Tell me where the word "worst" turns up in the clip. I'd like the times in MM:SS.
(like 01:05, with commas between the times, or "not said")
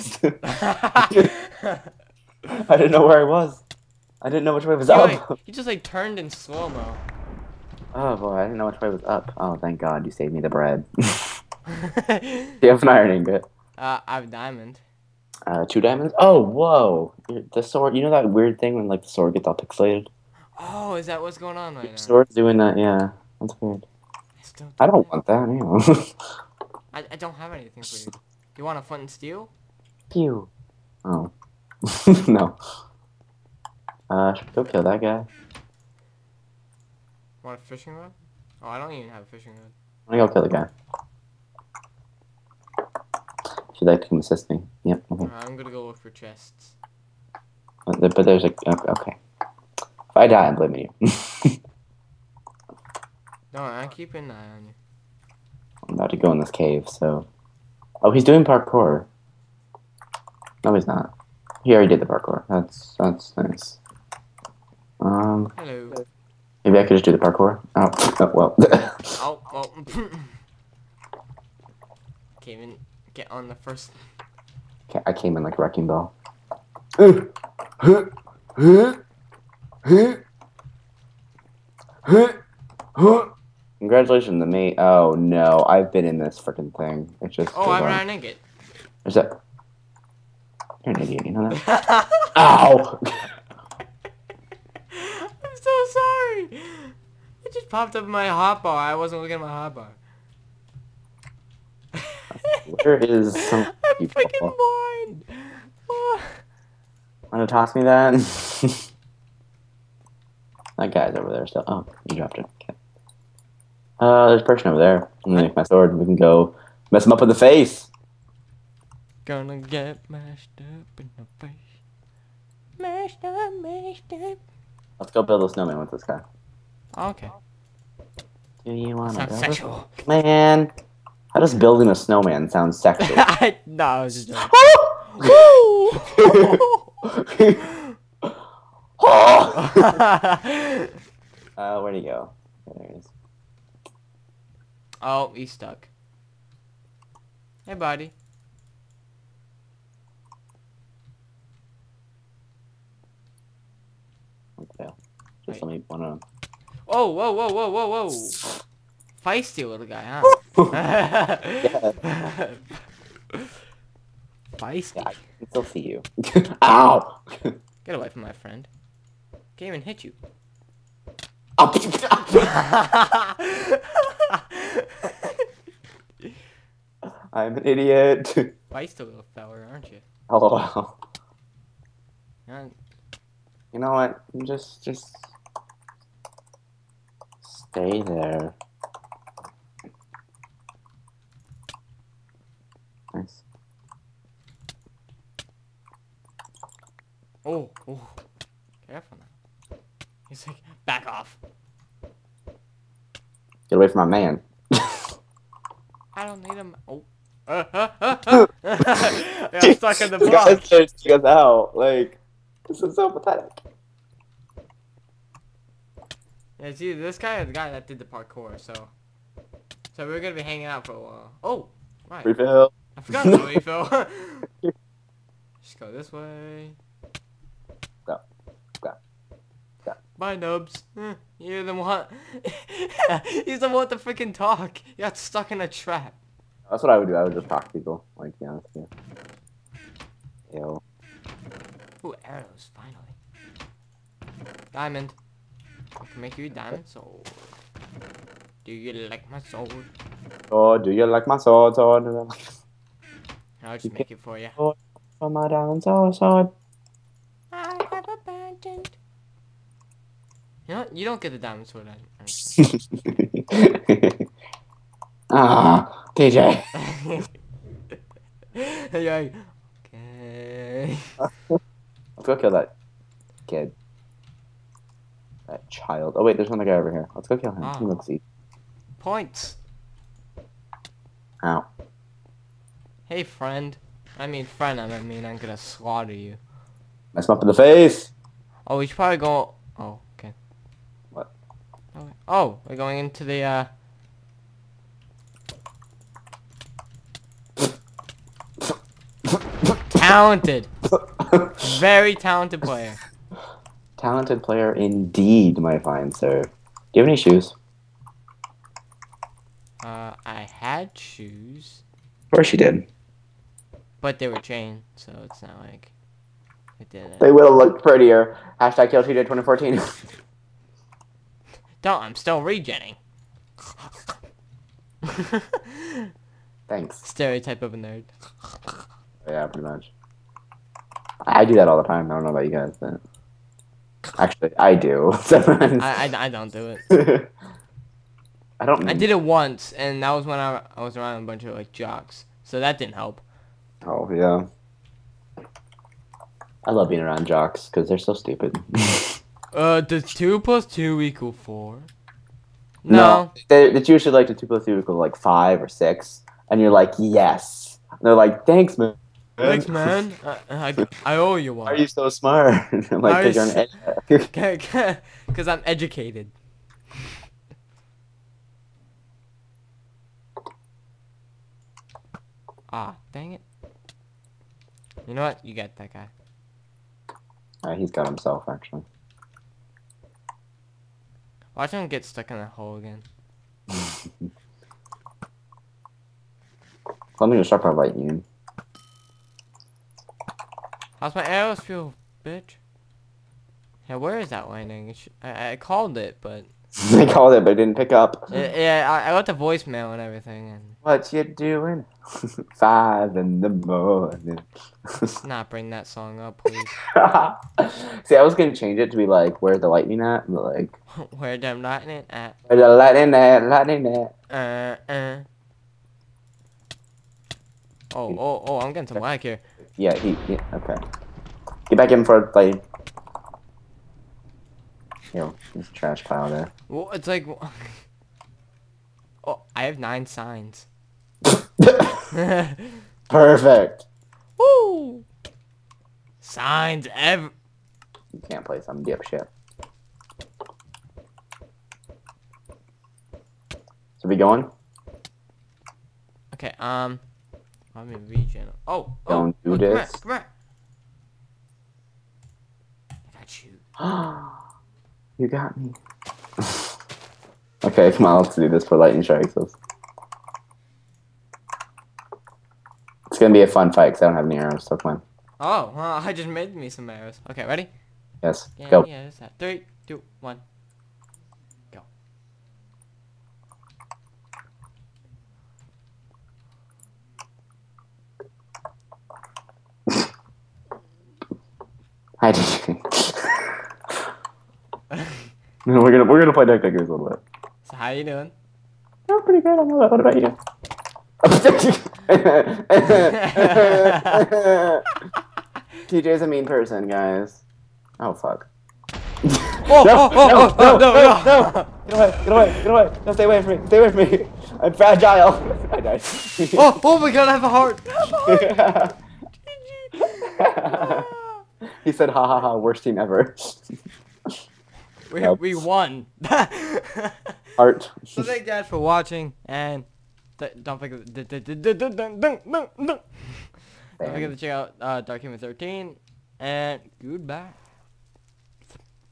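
08:32.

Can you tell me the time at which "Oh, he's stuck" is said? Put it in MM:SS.
02:25.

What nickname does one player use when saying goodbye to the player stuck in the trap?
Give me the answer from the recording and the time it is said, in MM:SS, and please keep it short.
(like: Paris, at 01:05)
Nubs, at 03:50.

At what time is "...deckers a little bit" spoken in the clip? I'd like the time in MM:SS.
08:06.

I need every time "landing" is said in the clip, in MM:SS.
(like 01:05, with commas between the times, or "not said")
06:34.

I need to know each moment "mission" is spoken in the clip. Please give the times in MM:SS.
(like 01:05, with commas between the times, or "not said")
not said.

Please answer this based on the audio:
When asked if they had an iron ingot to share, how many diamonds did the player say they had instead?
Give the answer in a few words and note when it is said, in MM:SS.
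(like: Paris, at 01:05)
2, at 00:15.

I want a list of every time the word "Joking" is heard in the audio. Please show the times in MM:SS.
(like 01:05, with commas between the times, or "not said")
02:14.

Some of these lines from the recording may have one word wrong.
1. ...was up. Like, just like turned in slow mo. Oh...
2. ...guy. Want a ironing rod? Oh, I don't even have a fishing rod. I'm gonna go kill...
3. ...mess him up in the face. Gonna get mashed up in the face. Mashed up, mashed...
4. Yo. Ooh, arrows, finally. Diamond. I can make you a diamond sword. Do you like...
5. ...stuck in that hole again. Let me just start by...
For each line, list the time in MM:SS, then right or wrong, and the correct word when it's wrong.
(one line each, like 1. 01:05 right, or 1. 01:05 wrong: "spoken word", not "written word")
1. 00:04 right
2. 00:35 wrong: "fishing", not "ironing"
3. 01:56 right
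4. 04:00 right
5. 06:22 right.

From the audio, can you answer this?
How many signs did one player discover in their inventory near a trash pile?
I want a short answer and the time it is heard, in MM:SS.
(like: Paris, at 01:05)
9, at 07:09.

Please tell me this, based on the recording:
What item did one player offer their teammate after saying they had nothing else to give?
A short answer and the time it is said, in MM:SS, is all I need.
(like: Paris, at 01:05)
Flint and steel, at 00:28.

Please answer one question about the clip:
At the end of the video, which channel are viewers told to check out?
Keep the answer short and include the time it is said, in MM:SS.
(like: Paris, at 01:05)
Darkhaven 13, at 08:45.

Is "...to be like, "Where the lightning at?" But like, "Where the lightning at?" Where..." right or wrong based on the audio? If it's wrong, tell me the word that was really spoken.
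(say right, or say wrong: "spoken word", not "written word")
right.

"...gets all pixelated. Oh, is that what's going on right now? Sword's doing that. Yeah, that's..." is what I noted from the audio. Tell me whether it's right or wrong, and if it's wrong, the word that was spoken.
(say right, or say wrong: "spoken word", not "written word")
right.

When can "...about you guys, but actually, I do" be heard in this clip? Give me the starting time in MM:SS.
05:32.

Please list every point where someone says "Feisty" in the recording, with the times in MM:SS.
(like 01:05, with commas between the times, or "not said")
02:39, 02:44.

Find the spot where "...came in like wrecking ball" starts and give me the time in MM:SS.
01:15.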